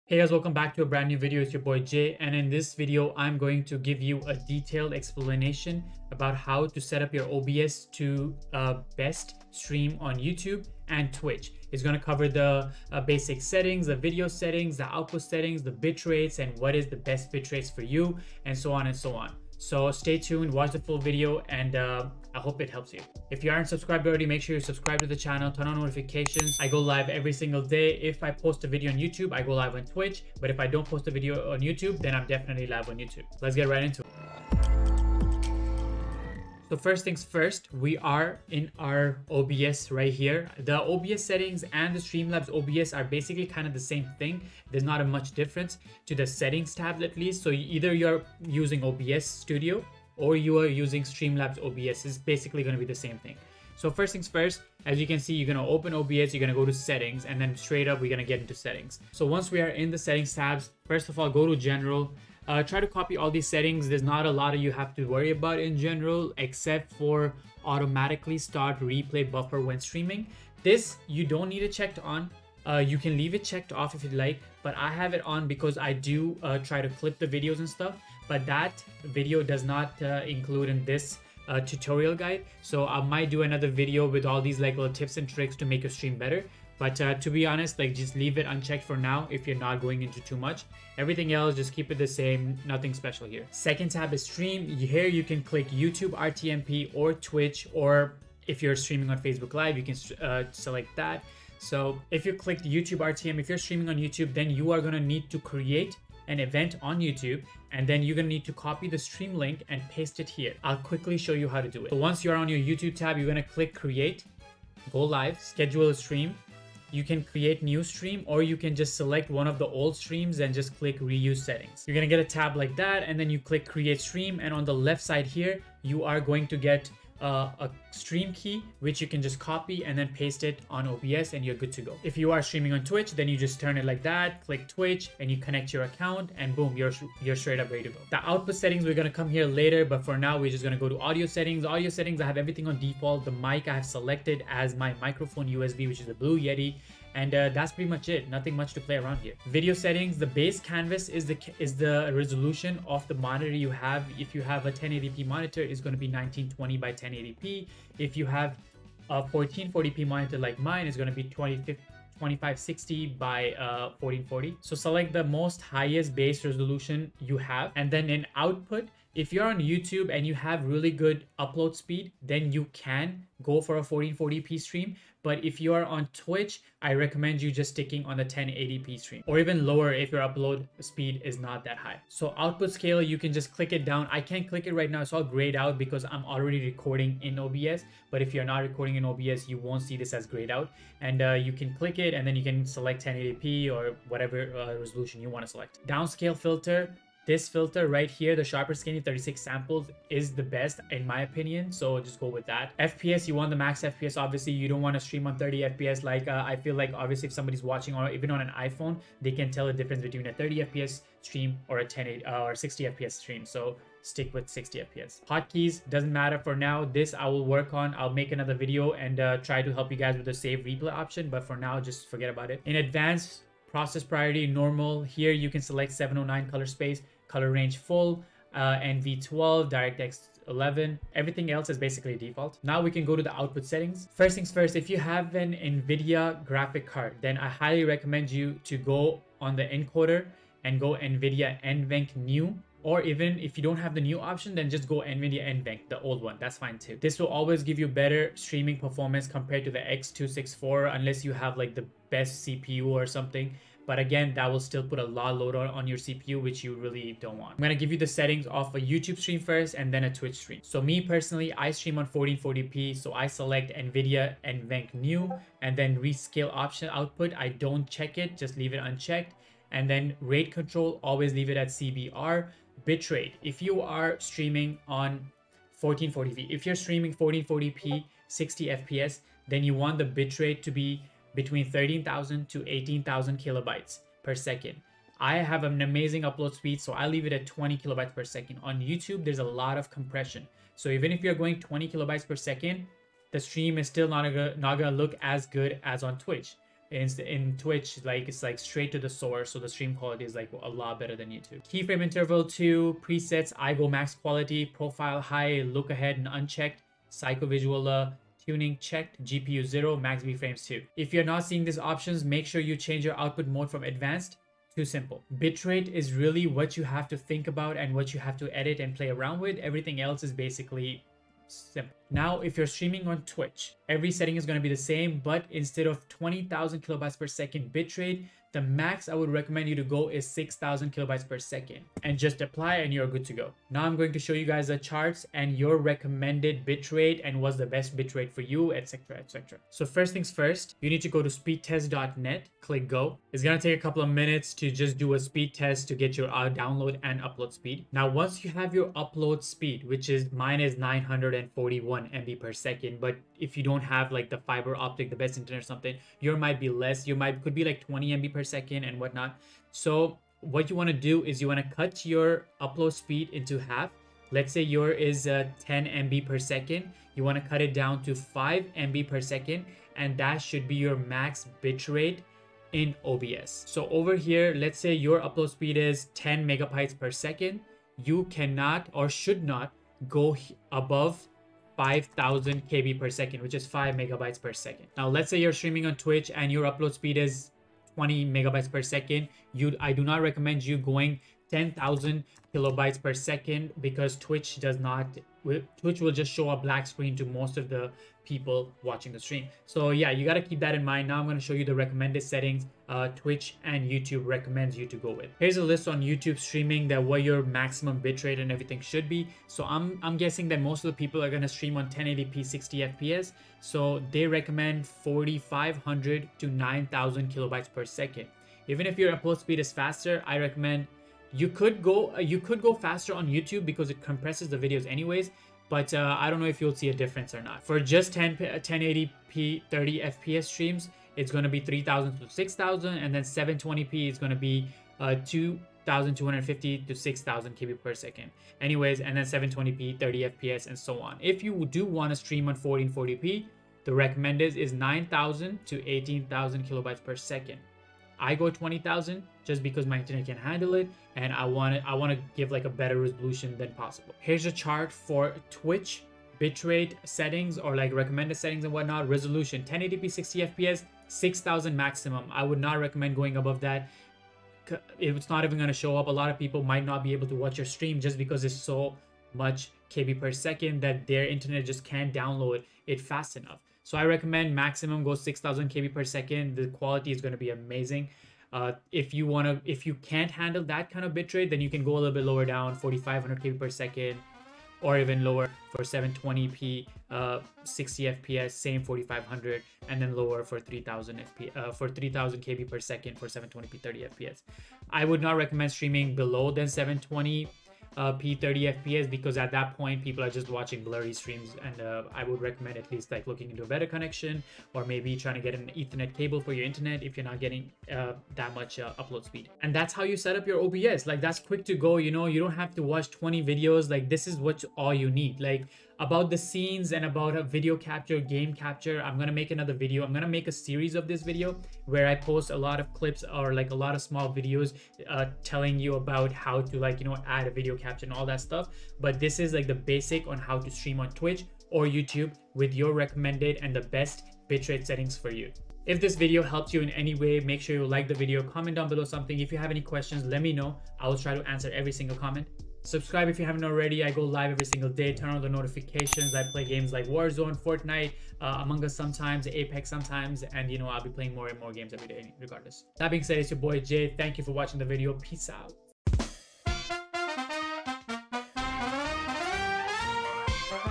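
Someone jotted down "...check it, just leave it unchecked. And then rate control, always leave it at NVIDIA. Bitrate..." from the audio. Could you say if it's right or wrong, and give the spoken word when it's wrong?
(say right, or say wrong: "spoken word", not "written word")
wrong: "CBR", not "NVIDIA".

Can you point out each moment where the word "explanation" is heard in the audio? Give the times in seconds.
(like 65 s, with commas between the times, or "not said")
4 s.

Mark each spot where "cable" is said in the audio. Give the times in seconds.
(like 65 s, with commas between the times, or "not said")
506 s.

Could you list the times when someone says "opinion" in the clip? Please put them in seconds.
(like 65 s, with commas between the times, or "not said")
201 s.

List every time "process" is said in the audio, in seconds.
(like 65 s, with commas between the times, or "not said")
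223 s.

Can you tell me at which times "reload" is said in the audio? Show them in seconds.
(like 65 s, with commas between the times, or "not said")
not said.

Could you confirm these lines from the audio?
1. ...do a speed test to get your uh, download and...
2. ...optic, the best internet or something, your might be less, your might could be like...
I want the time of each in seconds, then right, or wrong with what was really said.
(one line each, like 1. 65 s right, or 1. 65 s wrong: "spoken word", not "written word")
1. 344 s right
2. 354 s right.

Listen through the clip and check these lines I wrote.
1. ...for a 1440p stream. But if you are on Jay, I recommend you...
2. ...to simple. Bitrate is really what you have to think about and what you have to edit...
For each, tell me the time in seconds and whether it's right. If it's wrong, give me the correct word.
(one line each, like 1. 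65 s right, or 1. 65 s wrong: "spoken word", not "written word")
1. 173 s wrong: "Twitch", not "Jay"
2. 314 s right.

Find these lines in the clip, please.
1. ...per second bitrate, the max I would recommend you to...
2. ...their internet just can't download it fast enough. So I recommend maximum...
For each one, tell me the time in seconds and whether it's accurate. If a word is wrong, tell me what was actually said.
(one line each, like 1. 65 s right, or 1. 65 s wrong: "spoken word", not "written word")
1. 327 s right
2. 471 s right.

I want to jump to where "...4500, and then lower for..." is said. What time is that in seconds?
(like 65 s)
488 s.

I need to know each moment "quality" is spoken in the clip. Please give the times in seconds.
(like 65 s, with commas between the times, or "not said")
299 s, 304 s, 476 s.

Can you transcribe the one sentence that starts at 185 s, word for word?
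It's all grayed out because I'm already recording in OBS.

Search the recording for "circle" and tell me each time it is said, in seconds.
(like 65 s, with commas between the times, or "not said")
not said.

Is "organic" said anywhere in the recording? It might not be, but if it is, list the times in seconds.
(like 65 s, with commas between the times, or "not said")
not said.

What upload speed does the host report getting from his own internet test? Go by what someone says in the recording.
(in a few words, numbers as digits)
941 MB per second.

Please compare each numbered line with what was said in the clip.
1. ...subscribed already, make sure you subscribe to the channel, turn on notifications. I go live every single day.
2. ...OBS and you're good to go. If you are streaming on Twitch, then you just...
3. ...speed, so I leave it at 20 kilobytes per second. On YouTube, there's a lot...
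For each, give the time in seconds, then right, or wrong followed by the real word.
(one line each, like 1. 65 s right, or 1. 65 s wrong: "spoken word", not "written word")
1. 23 s right
2. 130 s right
3. 286 s right.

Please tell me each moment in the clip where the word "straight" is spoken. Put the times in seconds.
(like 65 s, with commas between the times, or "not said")
57 s, 137 s, 298 s.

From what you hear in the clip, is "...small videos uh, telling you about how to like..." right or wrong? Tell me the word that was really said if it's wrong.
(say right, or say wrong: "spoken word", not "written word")
right.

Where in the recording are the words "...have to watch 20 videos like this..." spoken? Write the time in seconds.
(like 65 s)
512 s.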